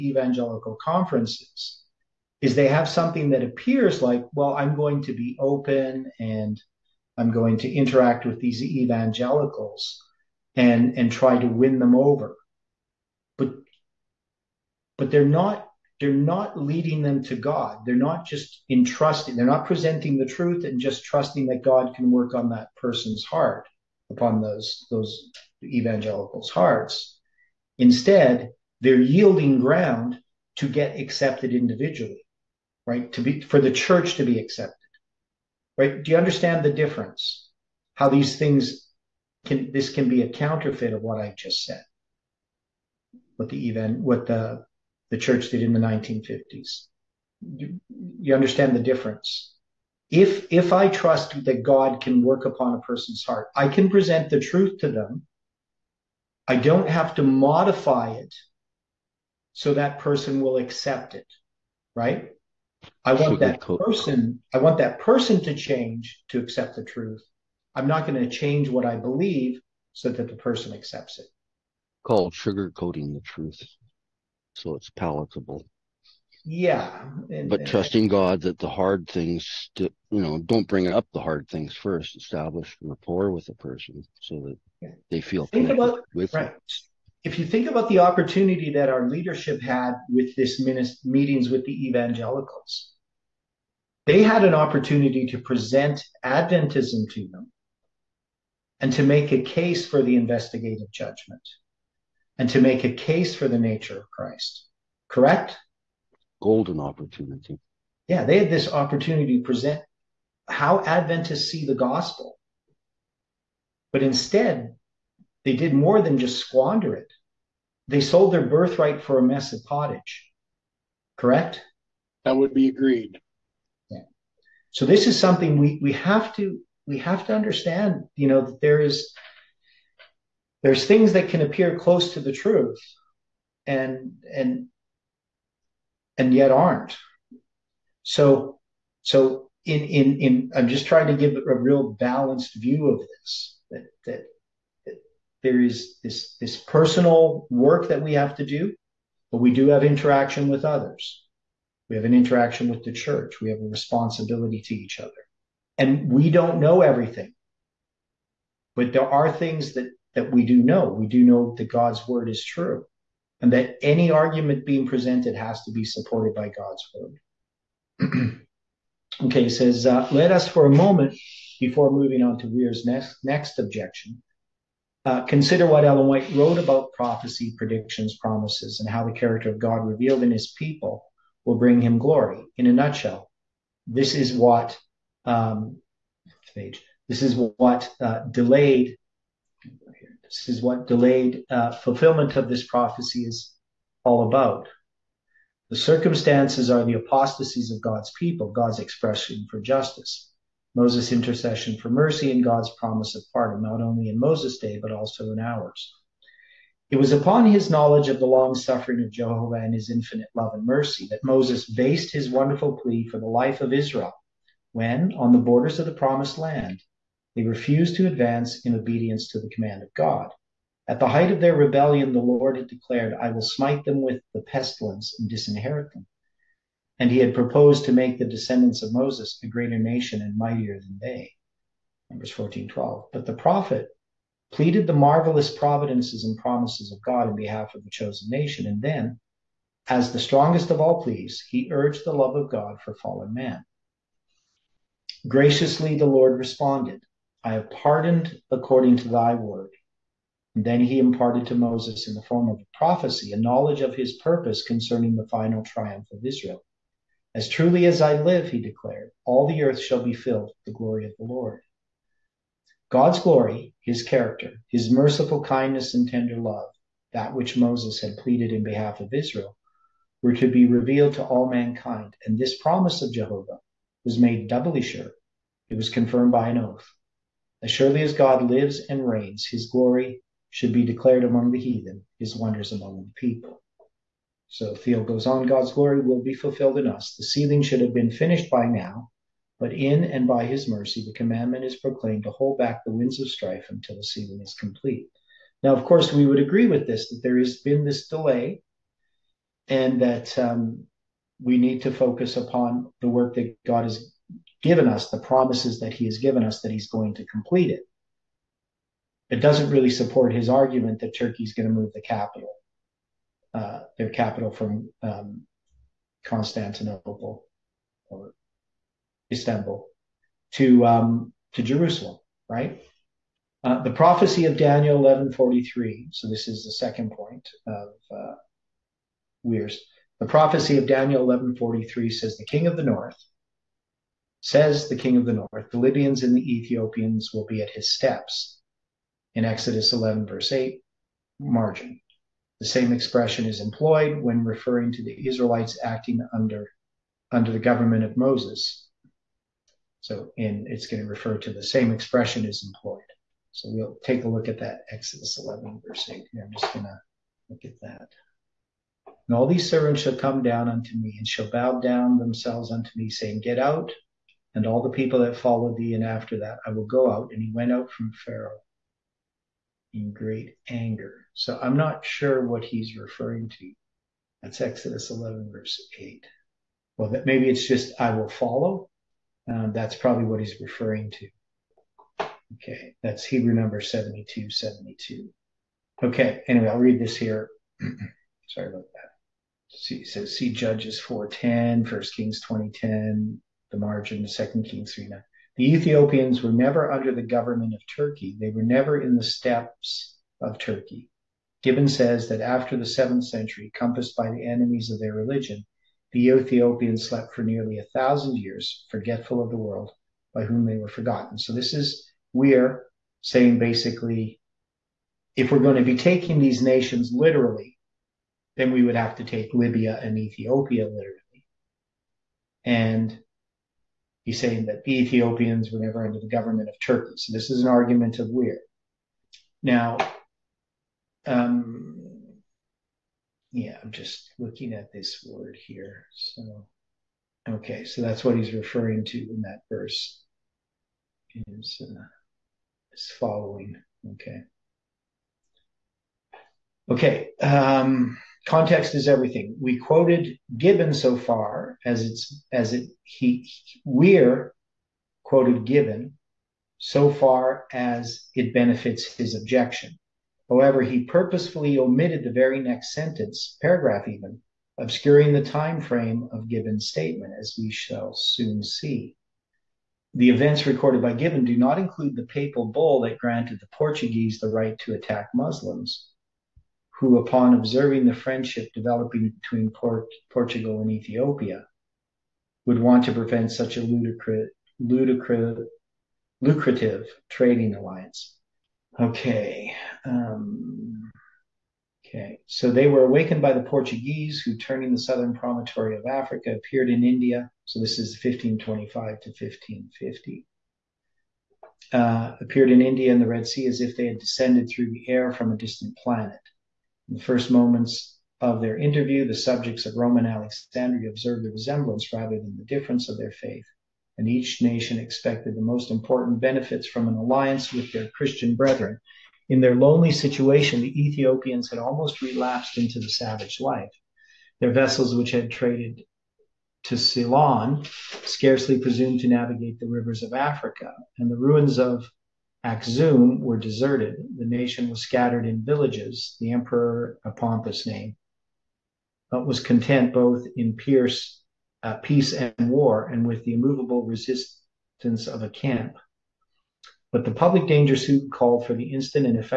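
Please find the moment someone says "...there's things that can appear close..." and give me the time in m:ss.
2:10.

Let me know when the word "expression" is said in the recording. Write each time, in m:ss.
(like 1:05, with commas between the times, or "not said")
3:18, 5:42, 5:51.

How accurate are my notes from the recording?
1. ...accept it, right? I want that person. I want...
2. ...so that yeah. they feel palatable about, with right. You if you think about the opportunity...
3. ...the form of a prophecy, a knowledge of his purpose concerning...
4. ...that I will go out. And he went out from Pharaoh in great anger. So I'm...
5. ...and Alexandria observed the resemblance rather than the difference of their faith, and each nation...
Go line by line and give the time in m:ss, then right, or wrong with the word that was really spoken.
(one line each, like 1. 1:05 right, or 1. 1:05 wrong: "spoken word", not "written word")
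1. 1:00 right
2. 1:24 wrong: "comfortable", not "palatable"
3. 4:12 right
4. 6:06 right
5. 8:30 right.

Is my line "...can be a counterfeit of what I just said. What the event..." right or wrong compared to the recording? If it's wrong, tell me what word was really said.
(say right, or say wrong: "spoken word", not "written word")
right.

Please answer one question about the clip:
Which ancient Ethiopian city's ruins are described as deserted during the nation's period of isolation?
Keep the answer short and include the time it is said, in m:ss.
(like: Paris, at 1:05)
Axum, at 8:52.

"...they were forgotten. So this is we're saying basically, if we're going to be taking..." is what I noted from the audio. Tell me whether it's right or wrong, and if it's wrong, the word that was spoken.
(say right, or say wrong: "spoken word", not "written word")
right.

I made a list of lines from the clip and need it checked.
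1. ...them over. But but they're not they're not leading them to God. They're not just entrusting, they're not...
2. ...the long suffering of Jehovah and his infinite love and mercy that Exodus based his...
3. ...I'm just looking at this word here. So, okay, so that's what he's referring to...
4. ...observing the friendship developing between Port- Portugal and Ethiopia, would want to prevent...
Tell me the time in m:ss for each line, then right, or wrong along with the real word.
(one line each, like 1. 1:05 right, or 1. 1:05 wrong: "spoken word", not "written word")
1. 0:11 right
2. 3:28 wrong: "Moses", not "Exodus"
3. 7:13 right
4. 7:57 right.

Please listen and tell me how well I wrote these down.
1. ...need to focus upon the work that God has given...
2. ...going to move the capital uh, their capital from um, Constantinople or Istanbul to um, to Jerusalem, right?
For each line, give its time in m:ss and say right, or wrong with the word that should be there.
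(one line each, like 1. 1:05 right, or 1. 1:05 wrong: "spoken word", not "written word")
1. 5:01 right
2. 5:11 right.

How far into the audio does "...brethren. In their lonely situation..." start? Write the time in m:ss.
8:38.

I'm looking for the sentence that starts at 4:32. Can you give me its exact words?
And this promise of Jehovah was made doubly sure.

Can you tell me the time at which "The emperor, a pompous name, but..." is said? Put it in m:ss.
8:56.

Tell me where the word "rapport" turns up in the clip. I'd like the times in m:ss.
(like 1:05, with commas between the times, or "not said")
1:22.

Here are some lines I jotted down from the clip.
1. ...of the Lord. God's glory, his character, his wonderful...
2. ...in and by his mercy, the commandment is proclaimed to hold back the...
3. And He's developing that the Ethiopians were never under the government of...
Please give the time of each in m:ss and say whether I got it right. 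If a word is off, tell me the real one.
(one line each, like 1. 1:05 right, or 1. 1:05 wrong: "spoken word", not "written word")
1. 4:21 wrong: "merciful", not "wonderful"
2. 4:49 right
3. 7:02 wrong: "saying", not "developing".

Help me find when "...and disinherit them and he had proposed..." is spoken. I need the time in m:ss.
3:45.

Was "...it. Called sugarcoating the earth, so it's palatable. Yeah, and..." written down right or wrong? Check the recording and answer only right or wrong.
wrong.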